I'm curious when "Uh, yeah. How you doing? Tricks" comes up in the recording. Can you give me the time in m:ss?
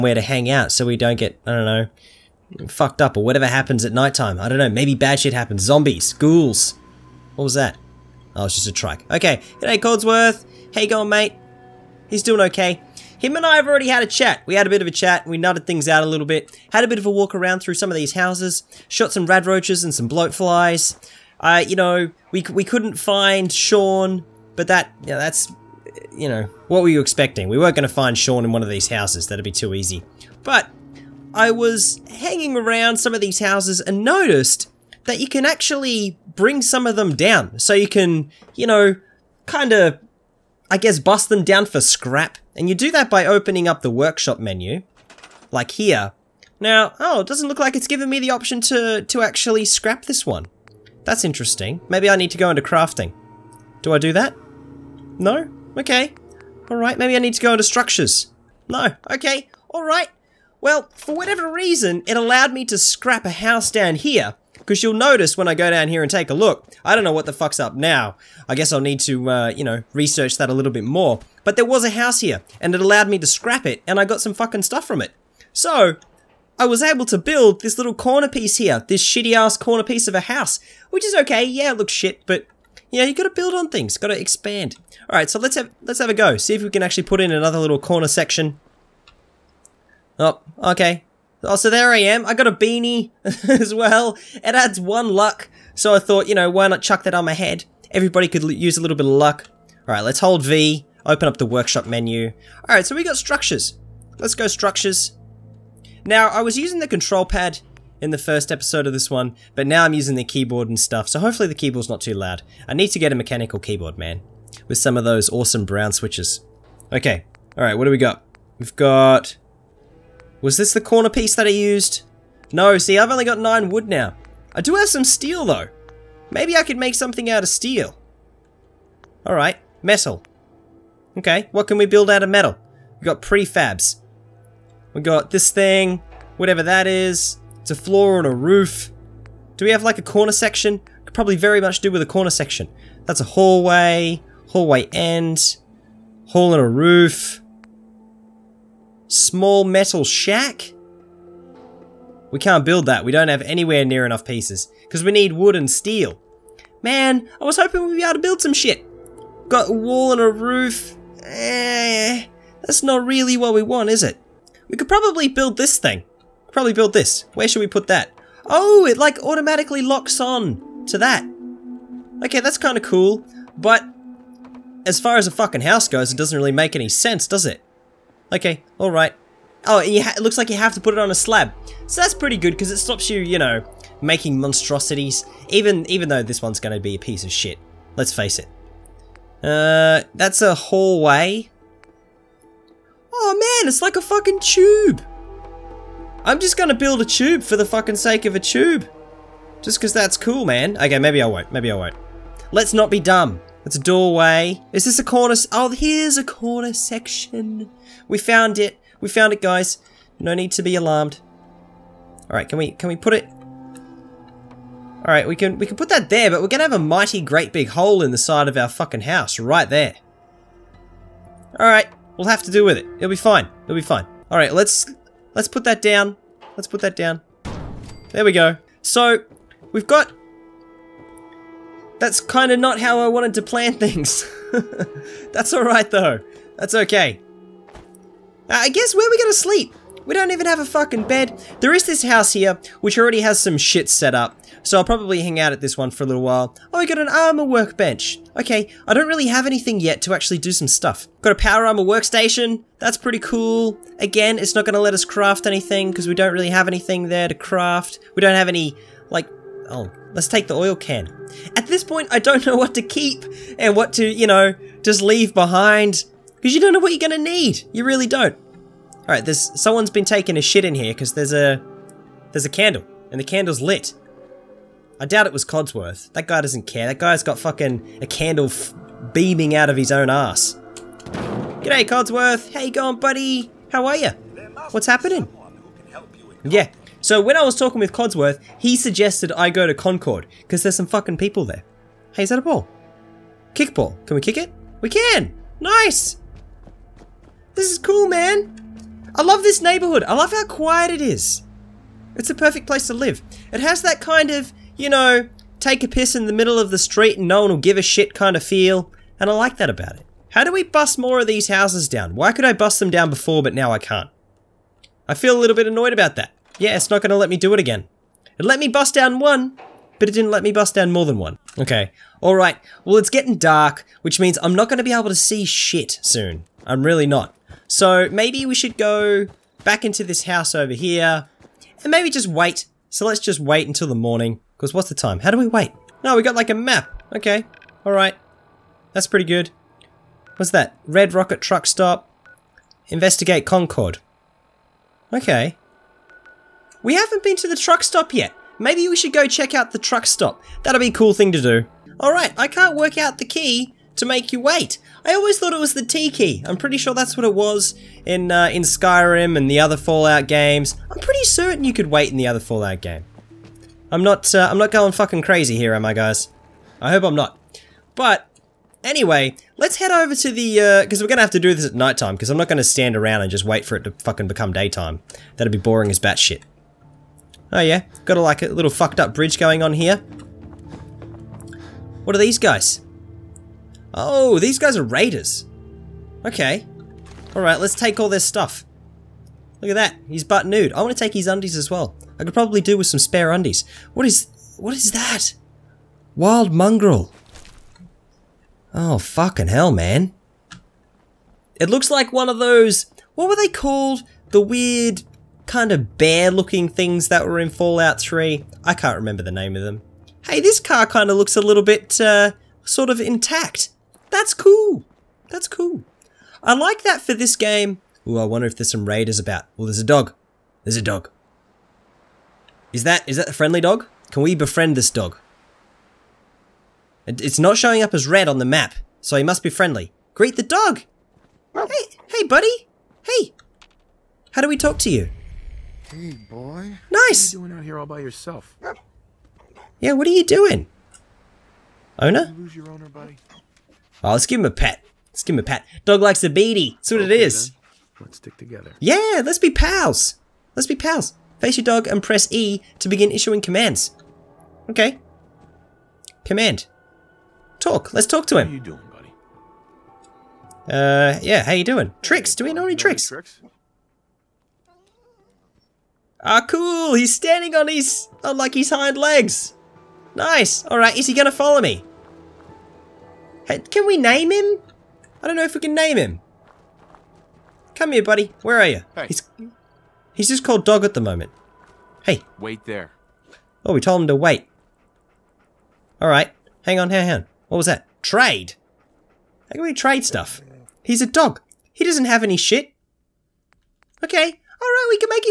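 7:40.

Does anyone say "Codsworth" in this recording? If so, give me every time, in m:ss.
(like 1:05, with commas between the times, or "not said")
4:35, 4:41, 4:47.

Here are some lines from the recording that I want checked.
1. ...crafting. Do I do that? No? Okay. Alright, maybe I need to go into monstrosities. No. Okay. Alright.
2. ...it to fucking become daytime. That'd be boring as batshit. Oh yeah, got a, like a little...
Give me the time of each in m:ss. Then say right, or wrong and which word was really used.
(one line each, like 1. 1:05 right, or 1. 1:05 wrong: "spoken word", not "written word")
1. 0:52 wrong: "structures", not "monstrosities"
2. 6:13 right.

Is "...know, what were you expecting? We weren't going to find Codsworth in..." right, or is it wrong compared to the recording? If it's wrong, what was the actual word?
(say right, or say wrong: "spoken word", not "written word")
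wrong: "Sean", not "Codsworth".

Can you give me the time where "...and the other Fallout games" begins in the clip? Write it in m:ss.
5:59.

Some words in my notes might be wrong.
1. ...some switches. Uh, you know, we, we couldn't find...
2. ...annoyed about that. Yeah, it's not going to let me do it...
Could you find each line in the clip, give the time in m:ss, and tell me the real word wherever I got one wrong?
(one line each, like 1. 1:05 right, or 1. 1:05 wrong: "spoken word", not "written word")
1. 0:19 wrong: "bloatflies", not "switches"
2. 5:15 right.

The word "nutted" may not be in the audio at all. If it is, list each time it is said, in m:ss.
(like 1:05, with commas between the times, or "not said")
0:15.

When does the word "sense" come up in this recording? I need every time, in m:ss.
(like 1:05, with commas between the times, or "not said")
2:56.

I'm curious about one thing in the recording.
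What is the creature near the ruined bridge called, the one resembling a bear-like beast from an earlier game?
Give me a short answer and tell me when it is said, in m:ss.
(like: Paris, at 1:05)
Wild mongrel, at 6:36.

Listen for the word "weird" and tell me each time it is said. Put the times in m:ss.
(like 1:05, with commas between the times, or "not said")
6:44.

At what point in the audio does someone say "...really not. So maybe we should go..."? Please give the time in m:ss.
5:26.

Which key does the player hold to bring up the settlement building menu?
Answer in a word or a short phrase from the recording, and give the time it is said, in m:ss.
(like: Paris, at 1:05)
V, at 1:40.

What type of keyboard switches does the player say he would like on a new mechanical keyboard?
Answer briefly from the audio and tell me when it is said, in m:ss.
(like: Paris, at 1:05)
Brown switches, at 1:55.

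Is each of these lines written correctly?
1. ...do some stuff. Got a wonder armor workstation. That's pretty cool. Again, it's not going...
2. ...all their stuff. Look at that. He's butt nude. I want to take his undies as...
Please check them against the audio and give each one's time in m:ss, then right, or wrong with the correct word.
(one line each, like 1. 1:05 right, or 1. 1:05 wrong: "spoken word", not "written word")
1. 4:10 wrong: "power", not "wonder"
2. 6:27 right.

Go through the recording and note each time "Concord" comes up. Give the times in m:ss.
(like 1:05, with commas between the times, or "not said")
4:49, 5:43.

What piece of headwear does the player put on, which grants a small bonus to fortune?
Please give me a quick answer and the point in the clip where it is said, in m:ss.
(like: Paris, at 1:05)
Beanie, at 1:32.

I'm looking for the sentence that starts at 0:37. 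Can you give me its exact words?
So you can, you know, kind of I guess bust them down for scrap.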